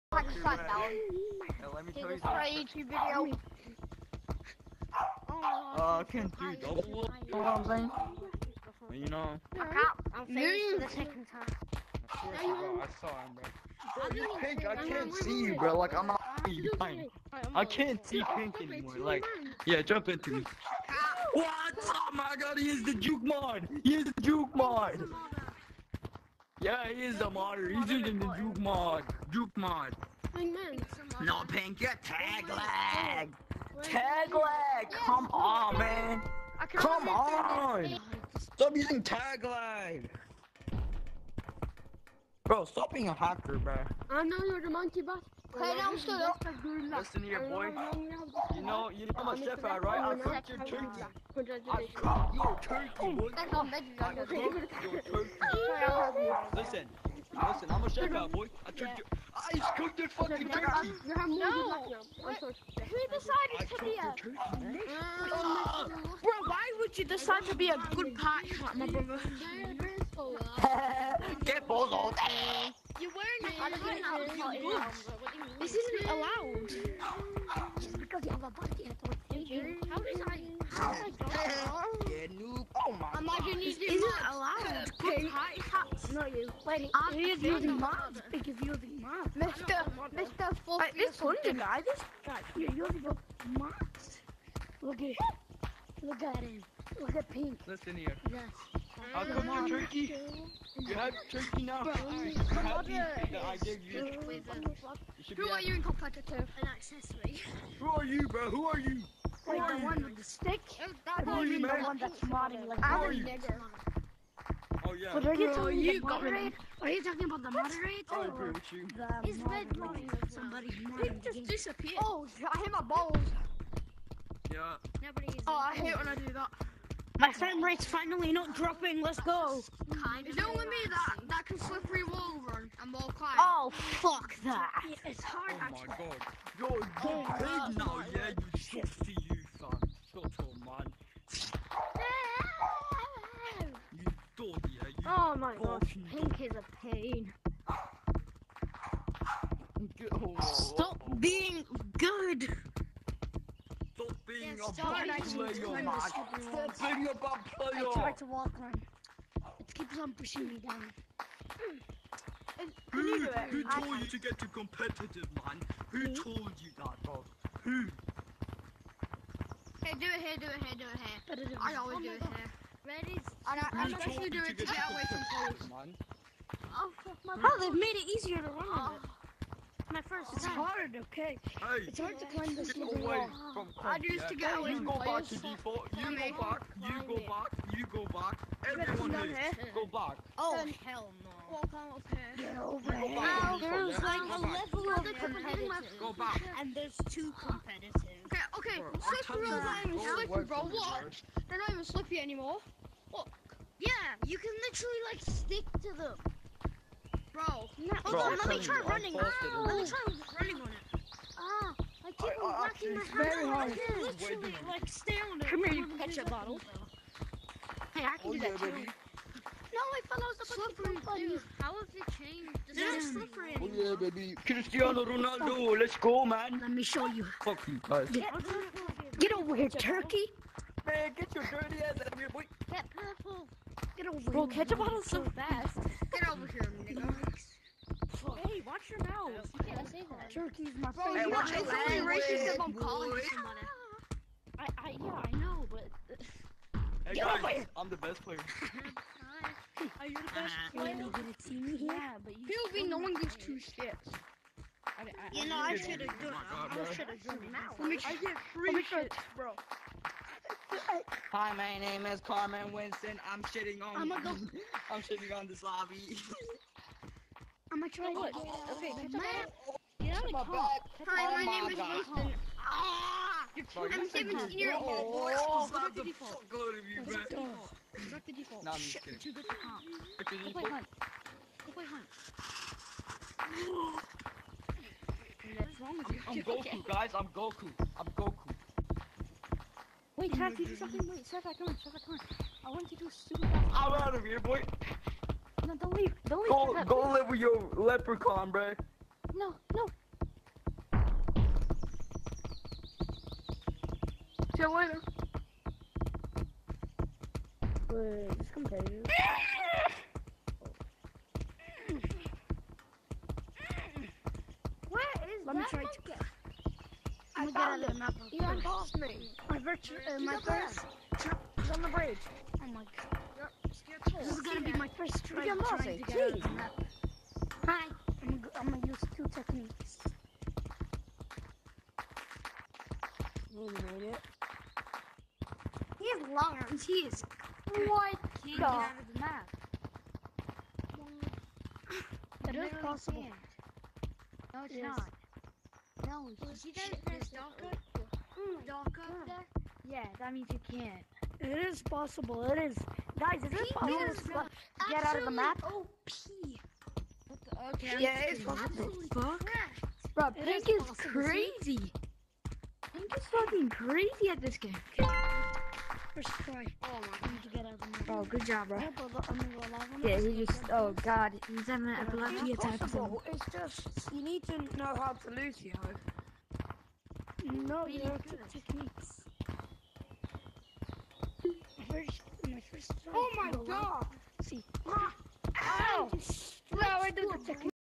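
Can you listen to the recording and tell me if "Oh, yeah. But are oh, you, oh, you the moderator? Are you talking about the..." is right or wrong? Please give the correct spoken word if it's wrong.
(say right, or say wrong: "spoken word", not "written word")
right.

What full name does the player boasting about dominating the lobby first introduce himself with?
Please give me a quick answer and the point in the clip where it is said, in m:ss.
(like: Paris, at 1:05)
Carmen Winston, at 4:22.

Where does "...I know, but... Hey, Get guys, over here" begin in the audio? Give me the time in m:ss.
4:05.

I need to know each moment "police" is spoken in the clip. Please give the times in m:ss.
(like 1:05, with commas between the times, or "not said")
2:55.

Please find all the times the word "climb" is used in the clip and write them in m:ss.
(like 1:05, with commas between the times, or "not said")
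2:13, 3:02.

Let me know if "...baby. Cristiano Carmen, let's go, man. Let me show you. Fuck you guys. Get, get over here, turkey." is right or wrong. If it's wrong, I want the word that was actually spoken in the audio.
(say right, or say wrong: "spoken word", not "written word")
wrong: "Ronaldo", not "Carmen".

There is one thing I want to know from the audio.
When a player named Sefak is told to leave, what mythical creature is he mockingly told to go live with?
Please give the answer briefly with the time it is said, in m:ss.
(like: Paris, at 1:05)
leprechaun, at 4:57.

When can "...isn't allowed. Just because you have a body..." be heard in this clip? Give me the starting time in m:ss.
1:15.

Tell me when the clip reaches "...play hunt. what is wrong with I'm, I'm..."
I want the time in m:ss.
4:41.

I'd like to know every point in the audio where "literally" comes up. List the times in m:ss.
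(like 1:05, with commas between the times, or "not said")
3:24, 3:34.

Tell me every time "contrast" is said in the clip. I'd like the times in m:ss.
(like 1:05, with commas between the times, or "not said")
not said.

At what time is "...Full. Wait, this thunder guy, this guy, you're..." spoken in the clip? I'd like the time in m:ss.
1:30.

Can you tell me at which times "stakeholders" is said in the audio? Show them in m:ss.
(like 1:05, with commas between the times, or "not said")
not said.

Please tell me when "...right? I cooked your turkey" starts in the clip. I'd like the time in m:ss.
0:49.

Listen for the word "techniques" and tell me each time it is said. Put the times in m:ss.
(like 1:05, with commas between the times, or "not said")
5:29, 6:18, 6:27.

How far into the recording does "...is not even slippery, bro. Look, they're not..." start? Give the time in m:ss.
3:19.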